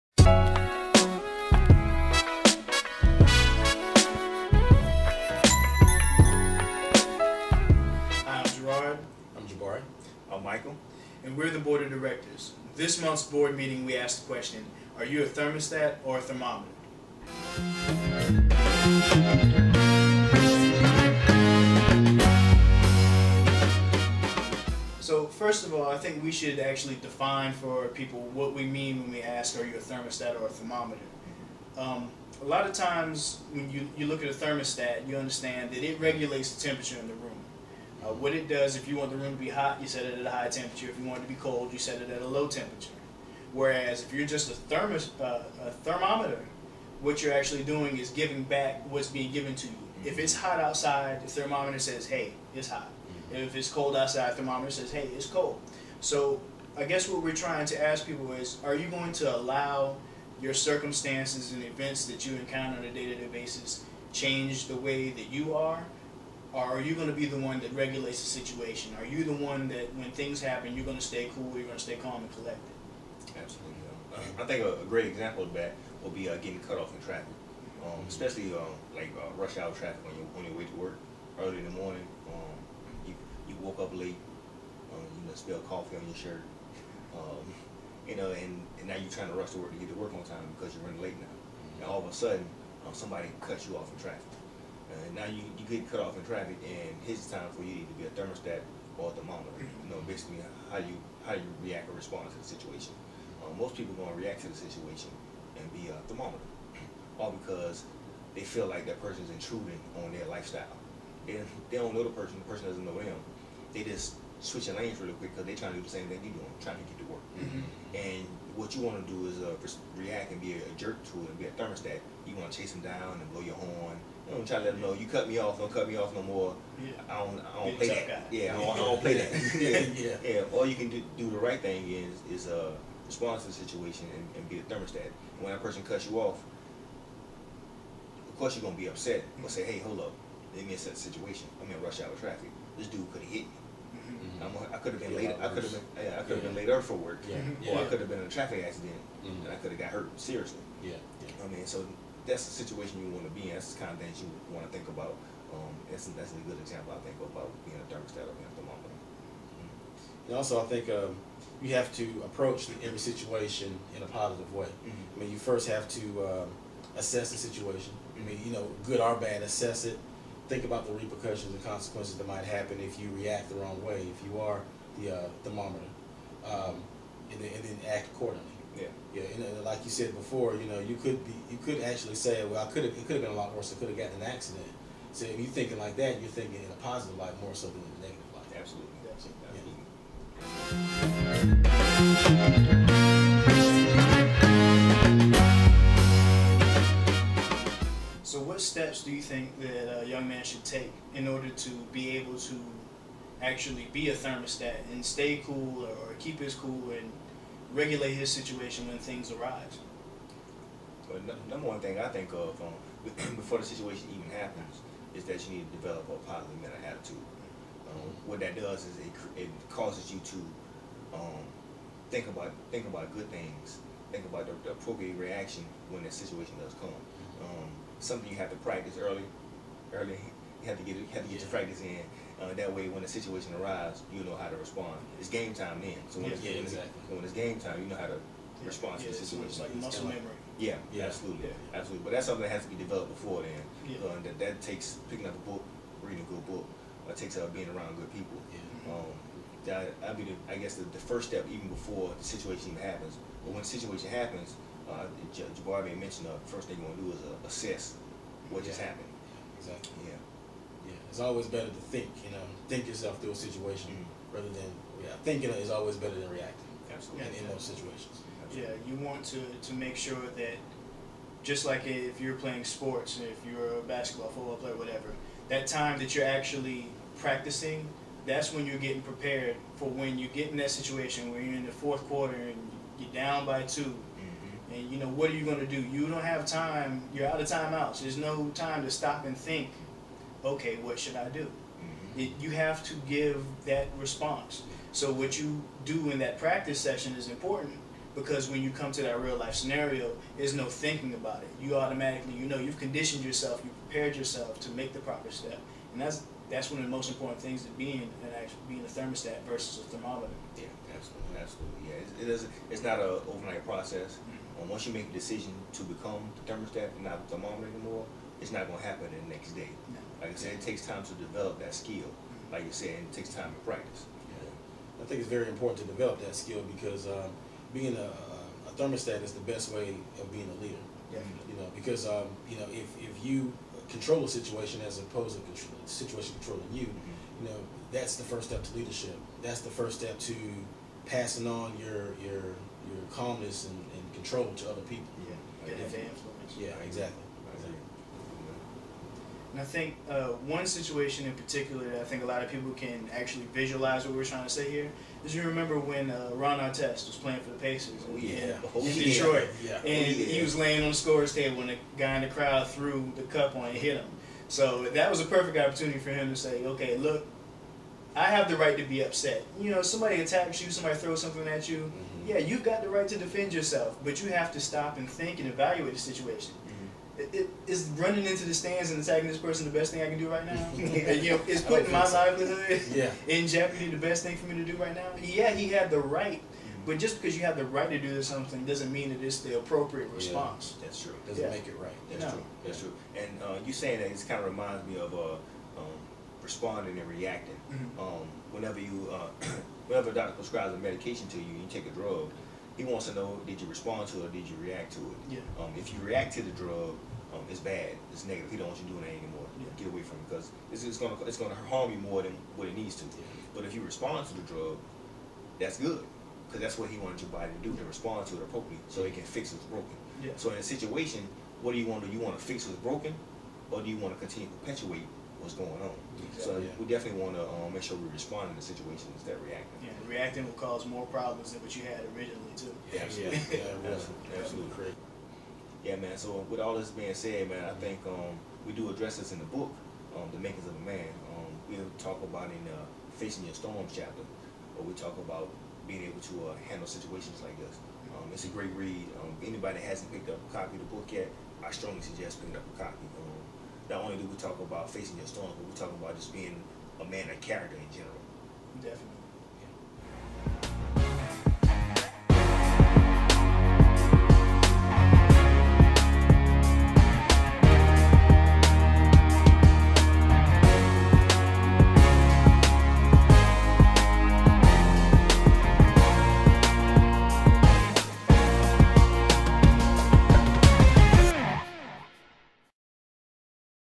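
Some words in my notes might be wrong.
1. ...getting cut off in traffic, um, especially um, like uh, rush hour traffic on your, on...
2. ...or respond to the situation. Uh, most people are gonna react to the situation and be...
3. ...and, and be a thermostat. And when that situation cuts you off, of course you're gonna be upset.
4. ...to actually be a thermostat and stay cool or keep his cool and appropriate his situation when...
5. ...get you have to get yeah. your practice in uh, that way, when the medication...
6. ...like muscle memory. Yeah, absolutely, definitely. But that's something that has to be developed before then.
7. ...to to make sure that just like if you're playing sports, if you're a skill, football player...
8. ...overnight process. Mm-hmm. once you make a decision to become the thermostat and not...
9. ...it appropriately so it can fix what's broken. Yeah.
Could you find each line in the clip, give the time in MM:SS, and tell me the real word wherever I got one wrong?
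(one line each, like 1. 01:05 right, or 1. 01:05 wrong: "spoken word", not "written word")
1. 01:16 right
2. 01:41 right
3. 02:14 wrong: "person", not "situation"
4. 03:22 wrong: "regulate", not "appropriate"
5. 03:50 wrong: "situation", not "medication"
6. 03:59 wrong: "absolutely", not "definitely"
7. 04:29 wrong: "basketball", not "skill"
8. 05:13 right
9. 06:58 right.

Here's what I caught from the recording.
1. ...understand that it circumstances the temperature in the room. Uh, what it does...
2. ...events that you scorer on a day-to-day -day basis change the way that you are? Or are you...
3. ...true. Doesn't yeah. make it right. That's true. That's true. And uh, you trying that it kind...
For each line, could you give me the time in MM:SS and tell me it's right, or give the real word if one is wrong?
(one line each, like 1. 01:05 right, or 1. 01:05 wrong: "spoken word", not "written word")
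1. 00:35 wrong: "regulates", not "circumstances"
2. 01:01 wrong: "encounter", not "scorer"
3. 06:31 wrong: "saying", not "trying".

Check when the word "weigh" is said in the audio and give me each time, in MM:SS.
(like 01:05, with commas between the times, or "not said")
not said.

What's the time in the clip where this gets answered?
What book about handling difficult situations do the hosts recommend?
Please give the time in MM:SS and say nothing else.
07:20.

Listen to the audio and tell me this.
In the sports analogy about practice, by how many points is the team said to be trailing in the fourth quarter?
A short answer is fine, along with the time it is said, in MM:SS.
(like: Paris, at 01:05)
2, at 04:43.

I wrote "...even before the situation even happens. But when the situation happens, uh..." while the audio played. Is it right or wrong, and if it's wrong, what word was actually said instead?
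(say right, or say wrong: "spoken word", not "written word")
right.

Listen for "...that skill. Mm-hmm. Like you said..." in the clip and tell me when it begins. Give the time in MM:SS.
05:21.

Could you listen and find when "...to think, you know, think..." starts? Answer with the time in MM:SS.
04:21.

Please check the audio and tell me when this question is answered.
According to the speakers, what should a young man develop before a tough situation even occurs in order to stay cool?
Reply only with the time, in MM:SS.
03:36.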